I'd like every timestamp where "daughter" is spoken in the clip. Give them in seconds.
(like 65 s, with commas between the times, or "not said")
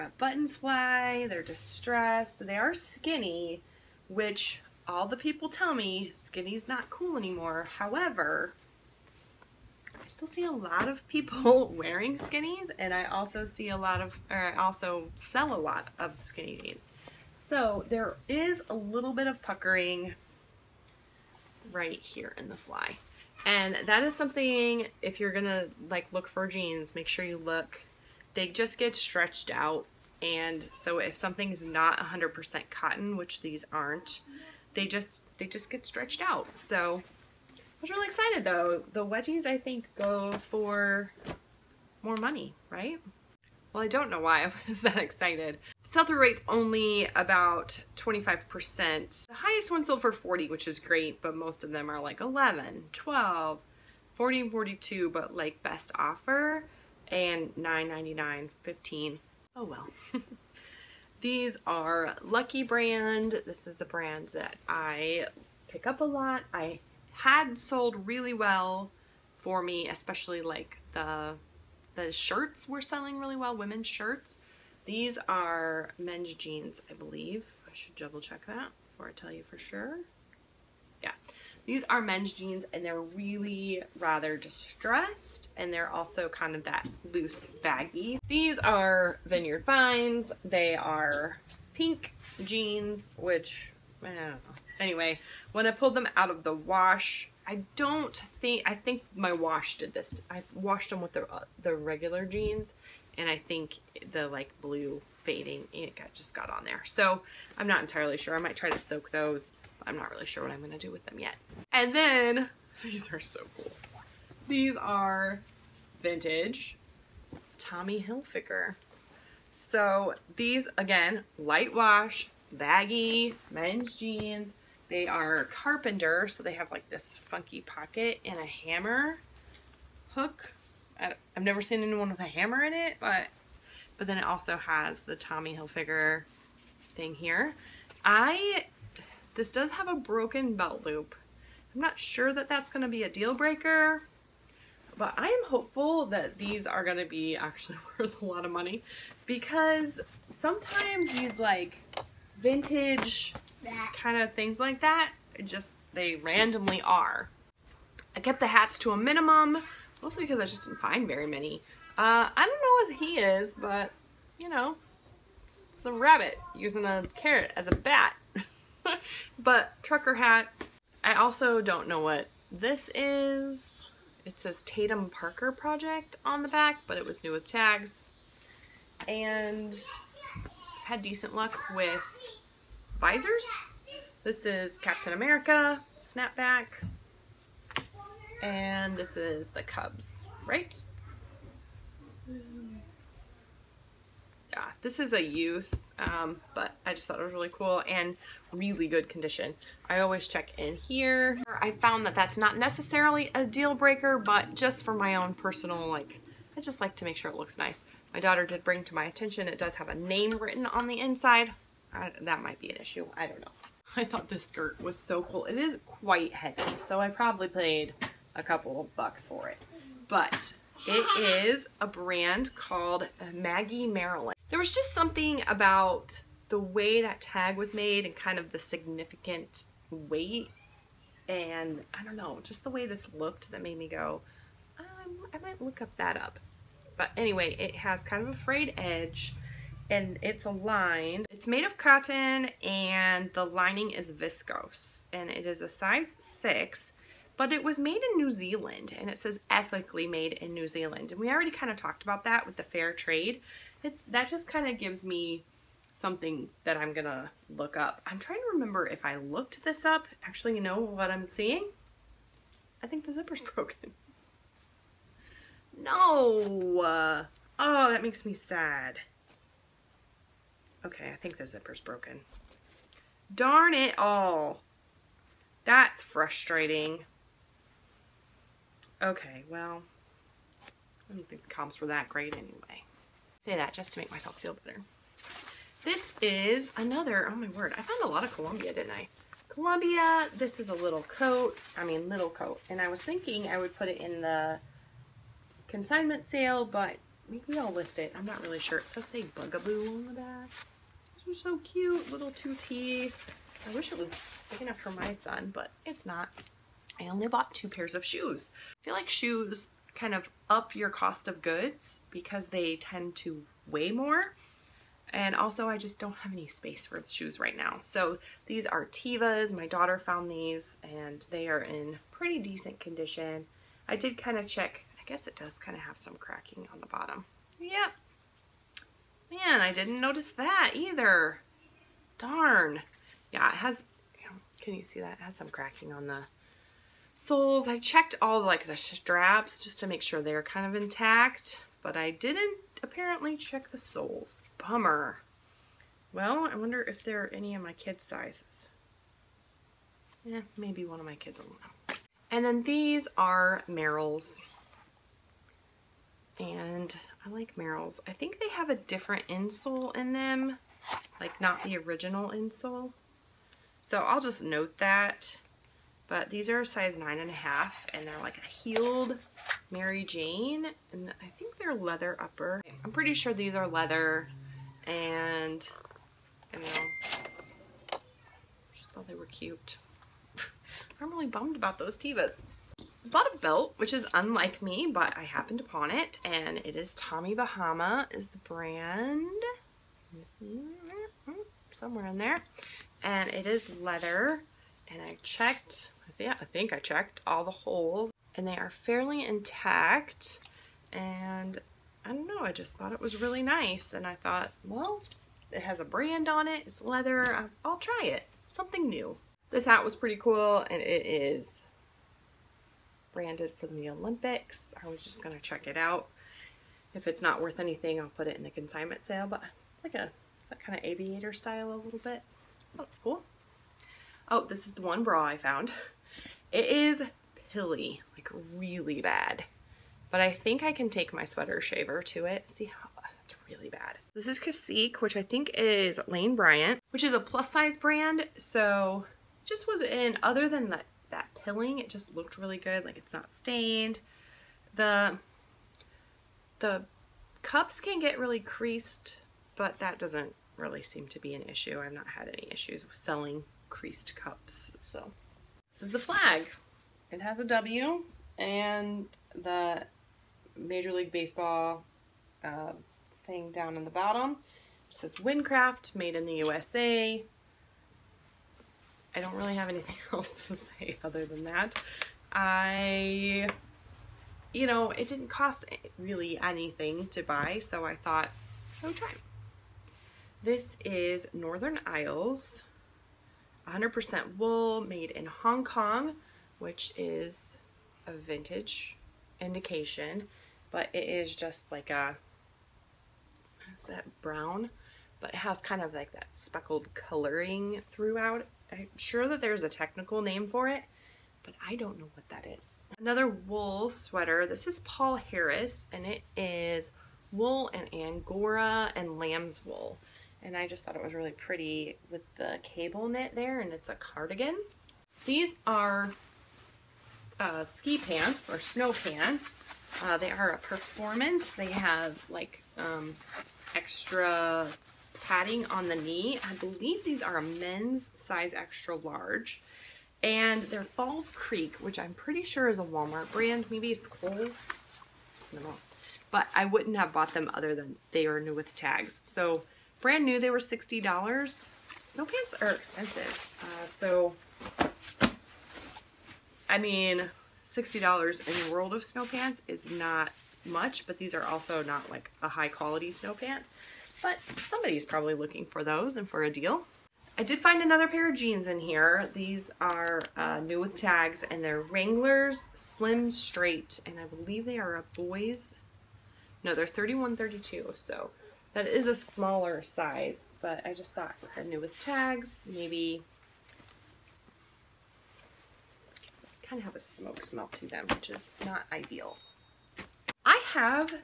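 208 s, 319 s.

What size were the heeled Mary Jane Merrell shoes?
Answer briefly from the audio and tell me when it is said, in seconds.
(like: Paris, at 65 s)
9.5, at 366 s.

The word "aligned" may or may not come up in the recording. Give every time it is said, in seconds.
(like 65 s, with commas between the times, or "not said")
240 s.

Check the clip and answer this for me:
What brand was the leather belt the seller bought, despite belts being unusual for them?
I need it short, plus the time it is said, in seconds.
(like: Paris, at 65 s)
Tommy Bahama, at 386 s.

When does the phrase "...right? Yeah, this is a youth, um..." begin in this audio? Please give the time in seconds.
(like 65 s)
190 s.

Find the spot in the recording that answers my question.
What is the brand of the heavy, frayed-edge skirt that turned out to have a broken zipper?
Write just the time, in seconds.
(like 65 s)
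223 s.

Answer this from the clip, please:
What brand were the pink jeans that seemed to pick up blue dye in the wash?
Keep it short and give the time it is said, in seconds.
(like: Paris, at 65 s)
Vineyard Vines, at 89 s.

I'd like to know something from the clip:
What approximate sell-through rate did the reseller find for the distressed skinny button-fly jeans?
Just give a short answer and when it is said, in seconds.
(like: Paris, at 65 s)
25%, at 47 s.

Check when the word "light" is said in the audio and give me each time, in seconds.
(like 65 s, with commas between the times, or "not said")
121 s.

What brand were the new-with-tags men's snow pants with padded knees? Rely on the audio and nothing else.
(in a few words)
Falls Creek.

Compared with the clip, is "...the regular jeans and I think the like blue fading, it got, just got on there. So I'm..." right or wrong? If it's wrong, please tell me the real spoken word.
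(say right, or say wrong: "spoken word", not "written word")
right.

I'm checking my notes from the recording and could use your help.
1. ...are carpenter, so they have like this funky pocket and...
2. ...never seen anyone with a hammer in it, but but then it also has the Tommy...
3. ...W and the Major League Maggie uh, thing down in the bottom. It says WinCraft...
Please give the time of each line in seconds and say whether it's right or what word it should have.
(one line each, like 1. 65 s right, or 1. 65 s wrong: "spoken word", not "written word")
1. 125 s right
2. 131 s right
3. 457 s wrong: "Baseball", not "Maggie".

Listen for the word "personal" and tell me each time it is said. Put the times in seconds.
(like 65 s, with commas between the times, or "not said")
205 s.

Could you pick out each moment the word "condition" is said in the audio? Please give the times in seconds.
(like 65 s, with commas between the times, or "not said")
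199 s, 322 s.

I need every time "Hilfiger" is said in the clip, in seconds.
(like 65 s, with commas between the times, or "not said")
118 s, 135 s.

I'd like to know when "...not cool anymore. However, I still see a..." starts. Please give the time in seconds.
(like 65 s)
6 s.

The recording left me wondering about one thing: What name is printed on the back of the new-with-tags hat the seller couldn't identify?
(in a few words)
Tatum Parker Project.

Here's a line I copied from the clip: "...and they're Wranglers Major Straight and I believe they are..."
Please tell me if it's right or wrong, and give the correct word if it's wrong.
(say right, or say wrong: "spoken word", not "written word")
wrong: "Slim", not "Major".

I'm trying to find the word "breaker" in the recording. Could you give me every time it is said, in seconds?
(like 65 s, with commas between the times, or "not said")
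143 s, 203 s.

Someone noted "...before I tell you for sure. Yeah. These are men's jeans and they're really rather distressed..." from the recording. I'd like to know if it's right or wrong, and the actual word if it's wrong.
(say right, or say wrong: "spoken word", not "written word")
right.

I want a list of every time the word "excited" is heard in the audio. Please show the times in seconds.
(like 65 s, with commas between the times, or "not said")
38 s, 44 s.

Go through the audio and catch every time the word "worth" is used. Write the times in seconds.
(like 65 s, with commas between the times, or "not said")
147 s, 417 s.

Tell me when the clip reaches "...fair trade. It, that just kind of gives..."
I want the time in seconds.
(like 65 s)
252 s.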